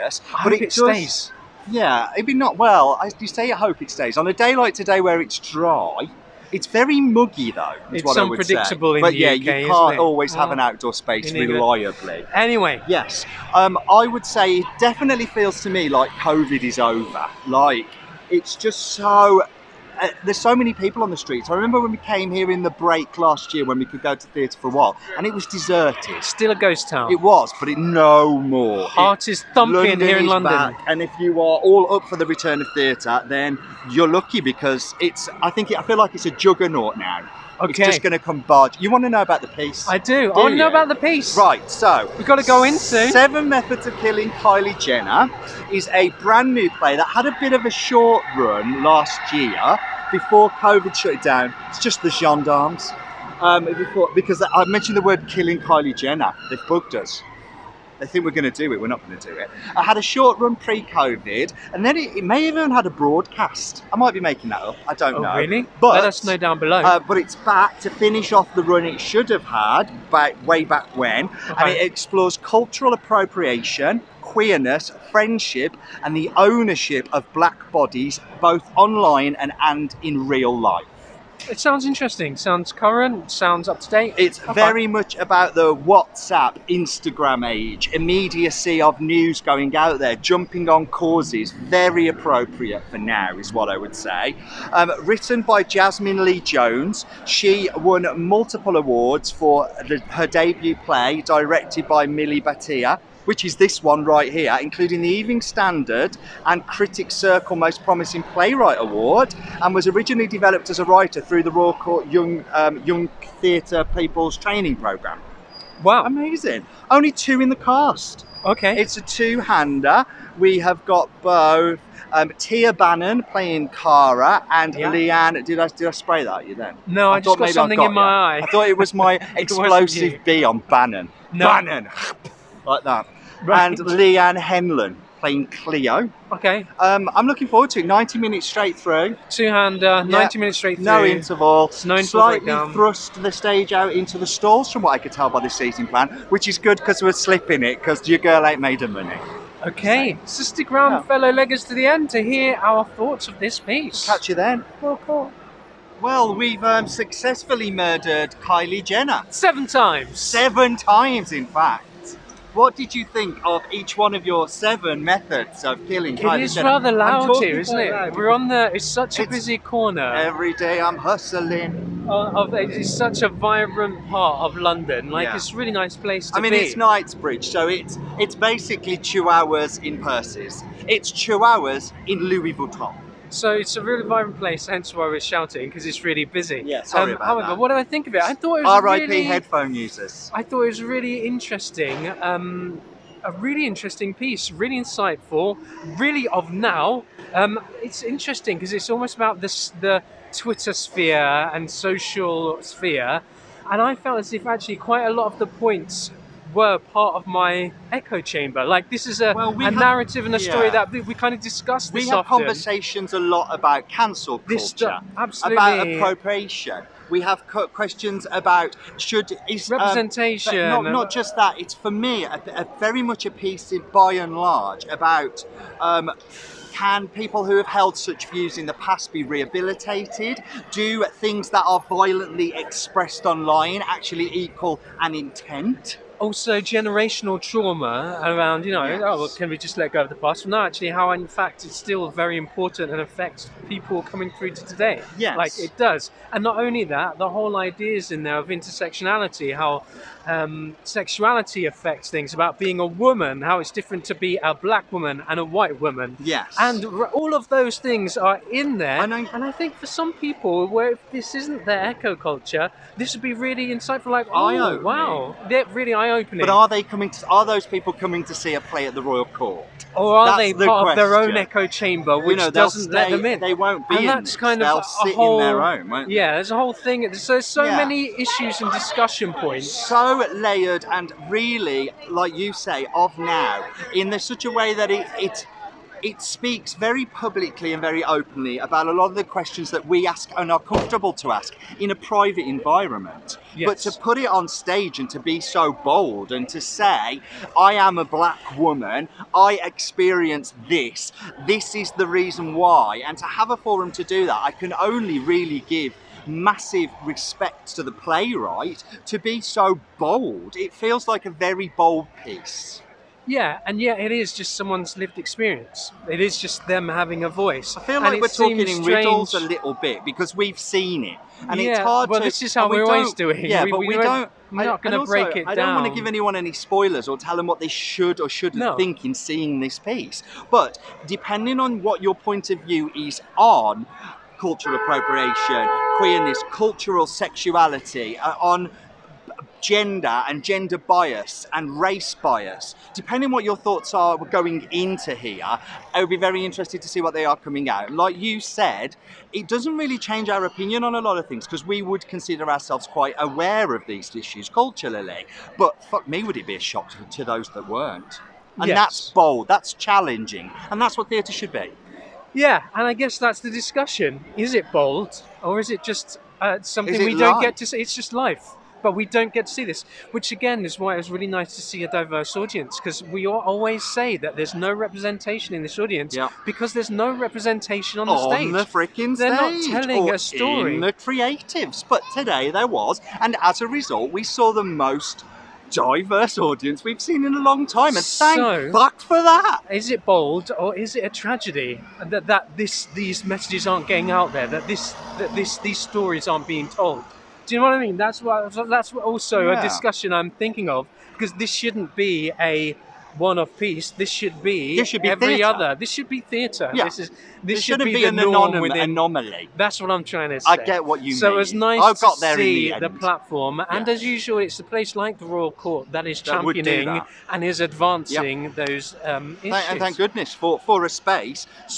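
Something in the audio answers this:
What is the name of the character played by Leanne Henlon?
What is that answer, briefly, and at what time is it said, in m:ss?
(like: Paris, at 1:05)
Cleo, at 2:15.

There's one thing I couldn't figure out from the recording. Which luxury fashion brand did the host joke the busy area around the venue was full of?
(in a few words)
Louis Vuitton.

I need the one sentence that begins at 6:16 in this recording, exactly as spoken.
because there's no representation on the on stage.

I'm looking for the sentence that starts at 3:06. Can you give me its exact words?
Yeah, sorry um, about However, that.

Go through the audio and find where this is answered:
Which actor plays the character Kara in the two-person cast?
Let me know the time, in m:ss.
2:02.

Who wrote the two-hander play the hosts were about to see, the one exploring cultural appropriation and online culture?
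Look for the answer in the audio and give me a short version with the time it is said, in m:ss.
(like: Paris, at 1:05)
Jasmine Lee Jones, at 1:35.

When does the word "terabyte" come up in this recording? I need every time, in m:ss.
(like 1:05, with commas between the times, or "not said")
not said.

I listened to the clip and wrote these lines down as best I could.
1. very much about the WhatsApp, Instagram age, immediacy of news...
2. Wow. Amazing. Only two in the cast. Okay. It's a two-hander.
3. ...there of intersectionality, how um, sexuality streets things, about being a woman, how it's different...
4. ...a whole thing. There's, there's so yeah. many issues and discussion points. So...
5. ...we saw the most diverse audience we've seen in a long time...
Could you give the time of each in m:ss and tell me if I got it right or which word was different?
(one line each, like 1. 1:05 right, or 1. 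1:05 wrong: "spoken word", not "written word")
1. 1:24 right
2. 1:55 right
3. 4:08 wrong: "affects", not "streets"
4. 4:36 right
5. 6:24 right.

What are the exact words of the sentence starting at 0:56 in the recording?
They've bugged us they think we're going to do it, we're not going to do it.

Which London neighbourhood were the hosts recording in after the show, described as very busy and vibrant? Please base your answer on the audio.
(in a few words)
Knightsbridge.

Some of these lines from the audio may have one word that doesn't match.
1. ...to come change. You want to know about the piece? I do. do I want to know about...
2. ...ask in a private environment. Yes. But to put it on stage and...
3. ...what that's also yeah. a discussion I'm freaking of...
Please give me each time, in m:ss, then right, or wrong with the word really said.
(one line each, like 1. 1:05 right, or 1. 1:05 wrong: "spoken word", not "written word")
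1. 0:38 wrong: "barge", not "change"
2. 4:51 right
3. 6:38 wrong: "thinking", not "freaking".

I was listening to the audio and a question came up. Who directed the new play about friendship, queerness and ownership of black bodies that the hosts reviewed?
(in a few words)
Milli Bhatia.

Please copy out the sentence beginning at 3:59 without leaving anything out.
oh, well, can we just let go of the past?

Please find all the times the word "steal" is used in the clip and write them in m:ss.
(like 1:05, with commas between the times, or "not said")
not said.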